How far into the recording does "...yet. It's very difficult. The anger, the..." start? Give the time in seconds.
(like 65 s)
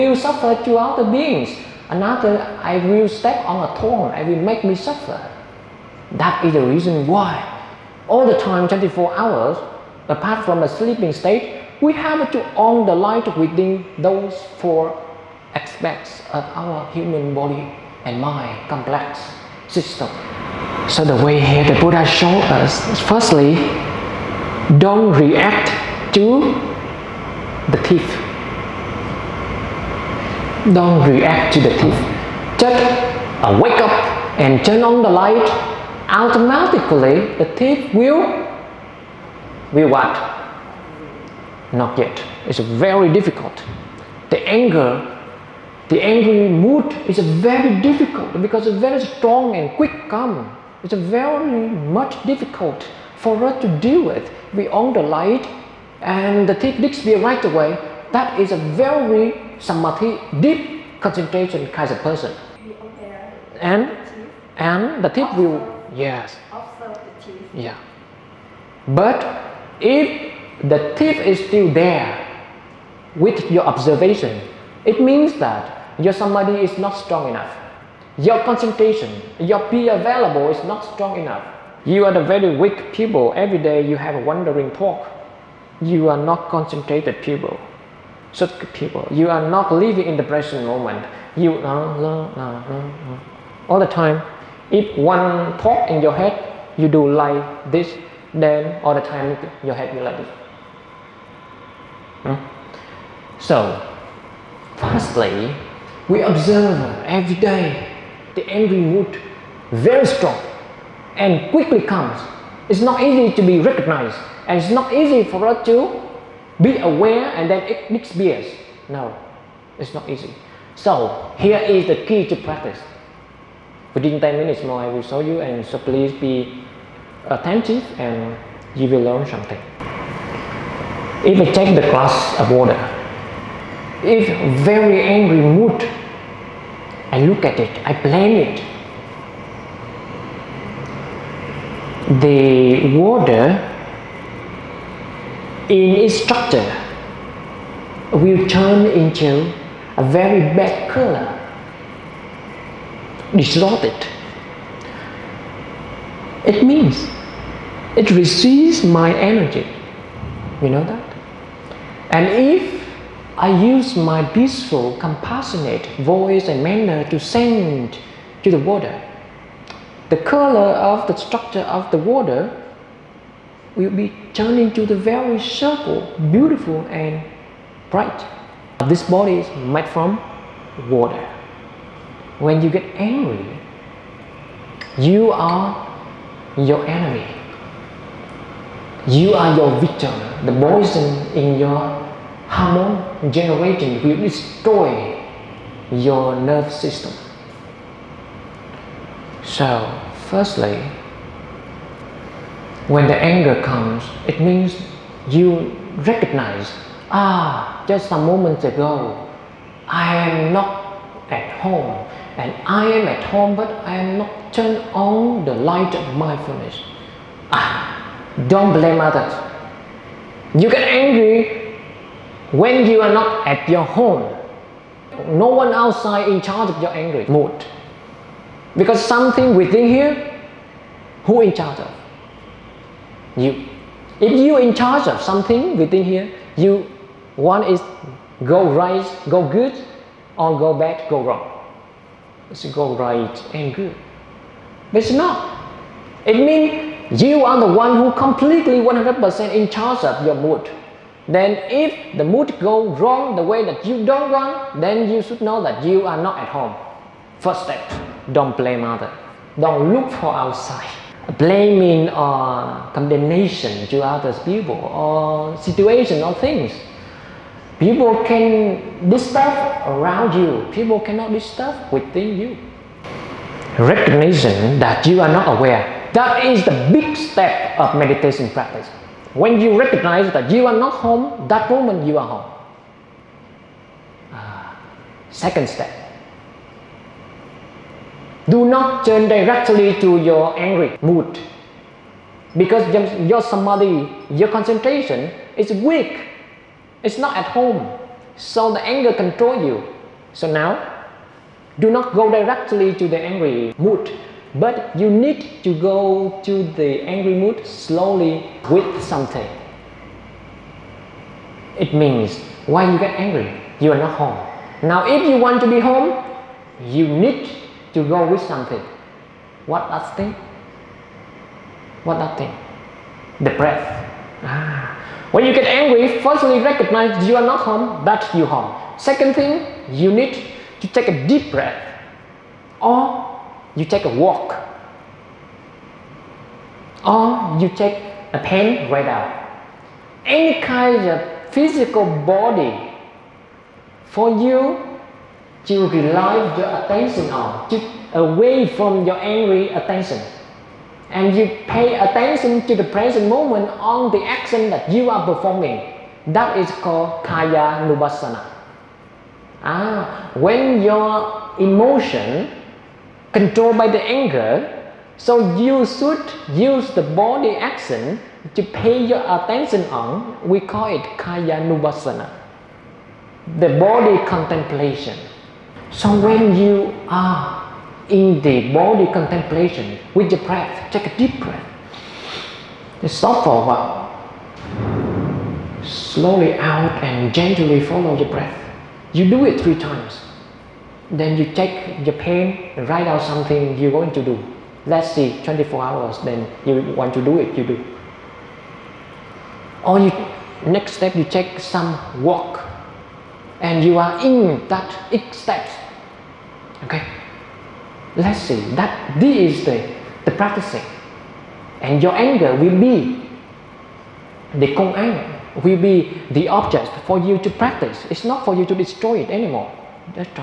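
41 s.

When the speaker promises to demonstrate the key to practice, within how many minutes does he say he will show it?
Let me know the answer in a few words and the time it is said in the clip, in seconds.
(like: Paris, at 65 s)
10, at 124 s.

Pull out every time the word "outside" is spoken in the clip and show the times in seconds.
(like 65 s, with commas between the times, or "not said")
225 s, 260 s.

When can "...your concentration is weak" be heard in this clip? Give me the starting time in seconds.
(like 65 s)
294 s.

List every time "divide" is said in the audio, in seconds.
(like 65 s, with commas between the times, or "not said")
not said.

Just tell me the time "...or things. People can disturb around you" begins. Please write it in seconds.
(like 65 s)
266 s.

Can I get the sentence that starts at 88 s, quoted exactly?
Such people, you are not living in the present moment.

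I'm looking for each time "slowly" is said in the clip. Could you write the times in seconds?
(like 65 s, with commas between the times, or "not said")
307 s, 385 s.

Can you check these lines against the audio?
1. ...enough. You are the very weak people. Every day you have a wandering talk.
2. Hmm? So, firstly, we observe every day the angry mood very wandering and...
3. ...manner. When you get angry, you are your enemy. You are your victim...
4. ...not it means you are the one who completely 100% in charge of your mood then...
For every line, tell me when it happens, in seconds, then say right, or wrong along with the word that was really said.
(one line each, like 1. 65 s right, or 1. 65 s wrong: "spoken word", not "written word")
1. 81 s right
2. 102 s wrong: "strong", not "wandering"
3. 180 s wrong: "water", not "manner"
4. 245 s right.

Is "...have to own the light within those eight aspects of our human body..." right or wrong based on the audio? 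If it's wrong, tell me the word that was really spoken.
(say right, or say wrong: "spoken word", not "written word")
wrong: "four", not "eight".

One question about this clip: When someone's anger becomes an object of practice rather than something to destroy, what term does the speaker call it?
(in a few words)
Kong An.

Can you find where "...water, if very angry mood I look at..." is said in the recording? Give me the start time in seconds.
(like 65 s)
132 s.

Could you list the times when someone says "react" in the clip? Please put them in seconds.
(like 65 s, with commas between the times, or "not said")
25 s, 31 s.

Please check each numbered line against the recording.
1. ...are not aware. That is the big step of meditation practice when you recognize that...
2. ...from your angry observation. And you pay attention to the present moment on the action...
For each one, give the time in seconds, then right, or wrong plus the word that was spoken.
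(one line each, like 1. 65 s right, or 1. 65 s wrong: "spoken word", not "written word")
1. 275 s right
2. 348 s wrong: "attention", not "observation".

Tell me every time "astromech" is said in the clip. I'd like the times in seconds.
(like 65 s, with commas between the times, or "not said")
not said.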